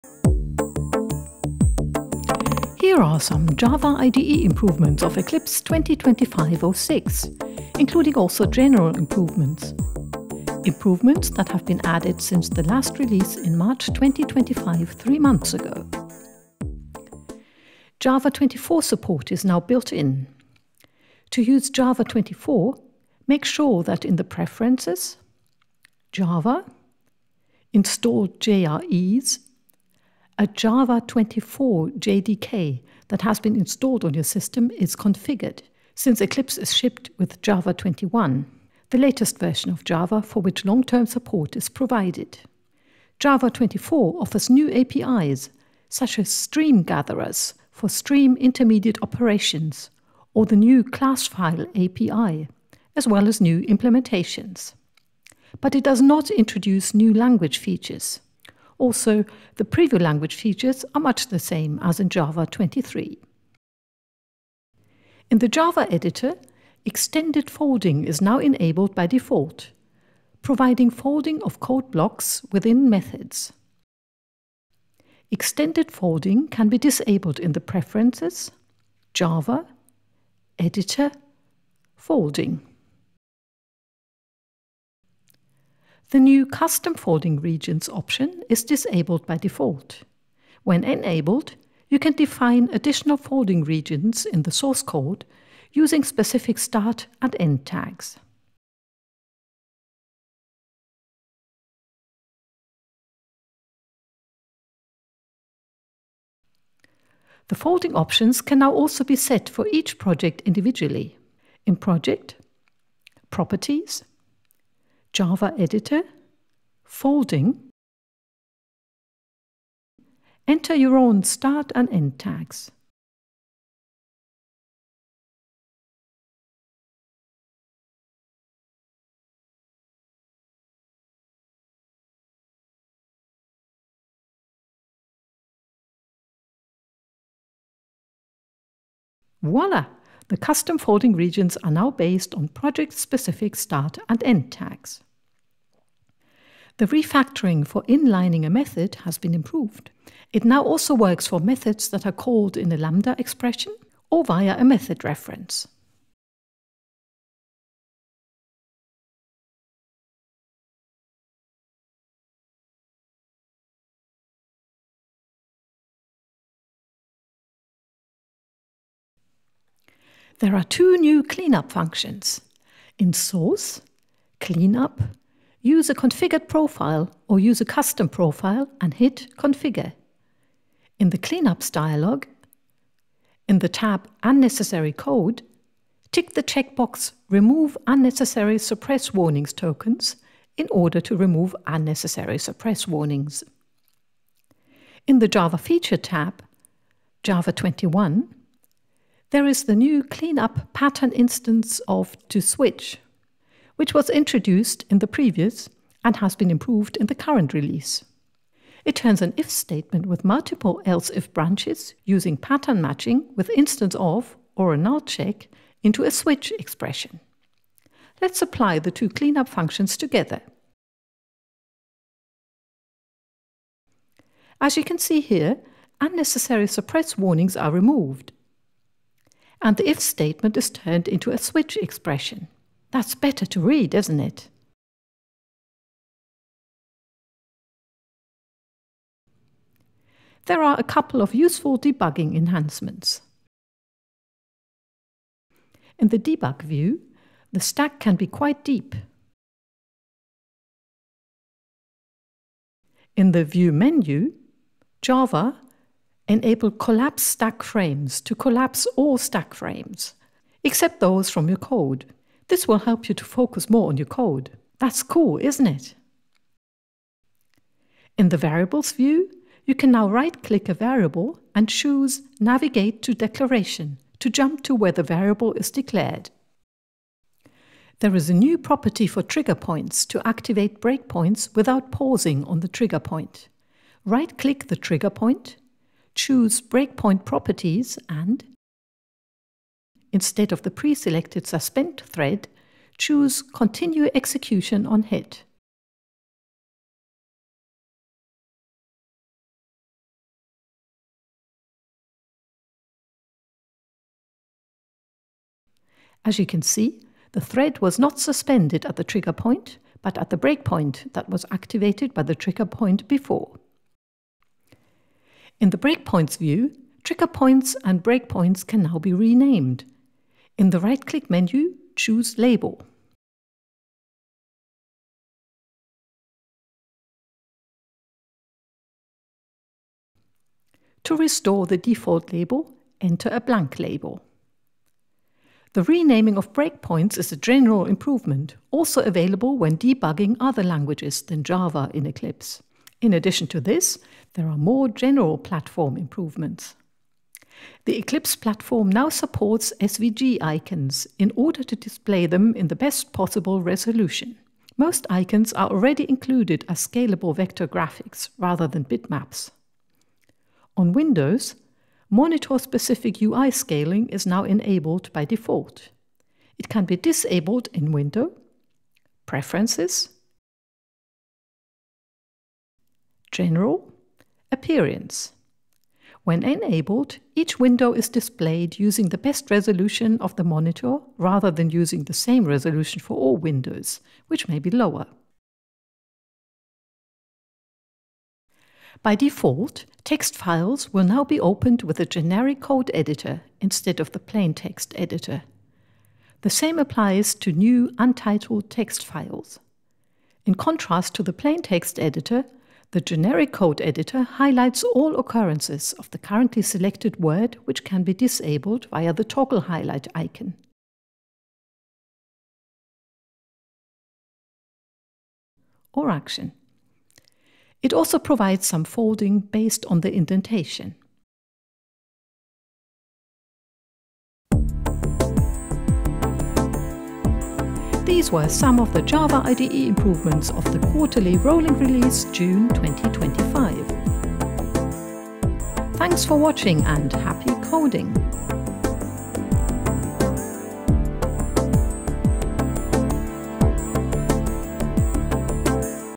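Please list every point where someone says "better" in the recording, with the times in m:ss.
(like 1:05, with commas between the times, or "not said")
3:53.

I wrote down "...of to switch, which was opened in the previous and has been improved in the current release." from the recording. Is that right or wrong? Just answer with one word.
wrong.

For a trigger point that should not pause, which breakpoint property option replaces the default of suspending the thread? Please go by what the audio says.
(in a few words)
continue execution on hit.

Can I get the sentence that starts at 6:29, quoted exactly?
By default, text files will now be opened with a generic code editor instead of the plain text editor.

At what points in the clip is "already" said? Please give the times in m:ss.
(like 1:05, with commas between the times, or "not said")
5:55.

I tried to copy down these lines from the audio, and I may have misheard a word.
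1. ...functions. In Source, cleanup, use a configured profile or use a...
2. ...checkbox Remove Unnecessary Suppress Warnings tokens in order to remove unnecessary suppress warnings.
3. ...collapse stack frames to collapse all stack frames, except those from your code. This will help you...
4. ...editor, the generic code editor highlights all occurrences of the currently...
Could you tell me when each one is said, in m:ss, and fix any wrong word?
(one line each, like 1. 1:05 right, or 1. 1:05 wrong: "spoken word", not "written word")
1. 2:51 right
2. 3:06 right
3. 4:16 right
4. 6:41 right.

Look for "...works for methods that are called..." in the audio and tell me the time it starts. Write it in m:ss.
2:30.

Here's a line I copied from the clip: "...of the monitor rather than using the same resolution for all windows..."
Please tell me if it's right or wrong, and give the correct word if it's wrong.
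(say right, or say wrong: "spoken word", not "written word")
right.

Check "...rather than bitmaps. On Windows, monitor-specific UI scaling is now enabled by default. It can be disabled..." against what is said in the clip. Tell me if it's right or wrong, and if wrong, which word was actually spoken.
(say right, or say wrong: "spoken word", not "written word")
right.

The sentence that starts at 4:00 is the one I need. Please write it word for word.
There are a couple of useful debugging enhancements.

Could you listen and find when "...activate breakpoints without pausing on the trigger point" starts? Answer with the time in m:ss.
4:40.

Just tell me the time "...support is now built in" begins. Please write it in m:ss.
0:18.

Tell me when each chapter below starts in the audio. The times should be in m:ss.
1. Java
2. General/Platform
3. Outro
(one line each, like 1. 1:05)
1. 0:18
2. 5:35
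3. 7:03.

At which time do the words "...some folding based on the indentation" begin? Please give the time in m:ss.
6:58.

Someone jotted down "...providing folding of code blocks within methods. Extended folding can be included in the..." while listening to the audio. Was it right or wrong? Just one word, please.
wrong.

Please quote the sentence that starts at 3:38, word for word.
Let's apply the two cleanup functions together.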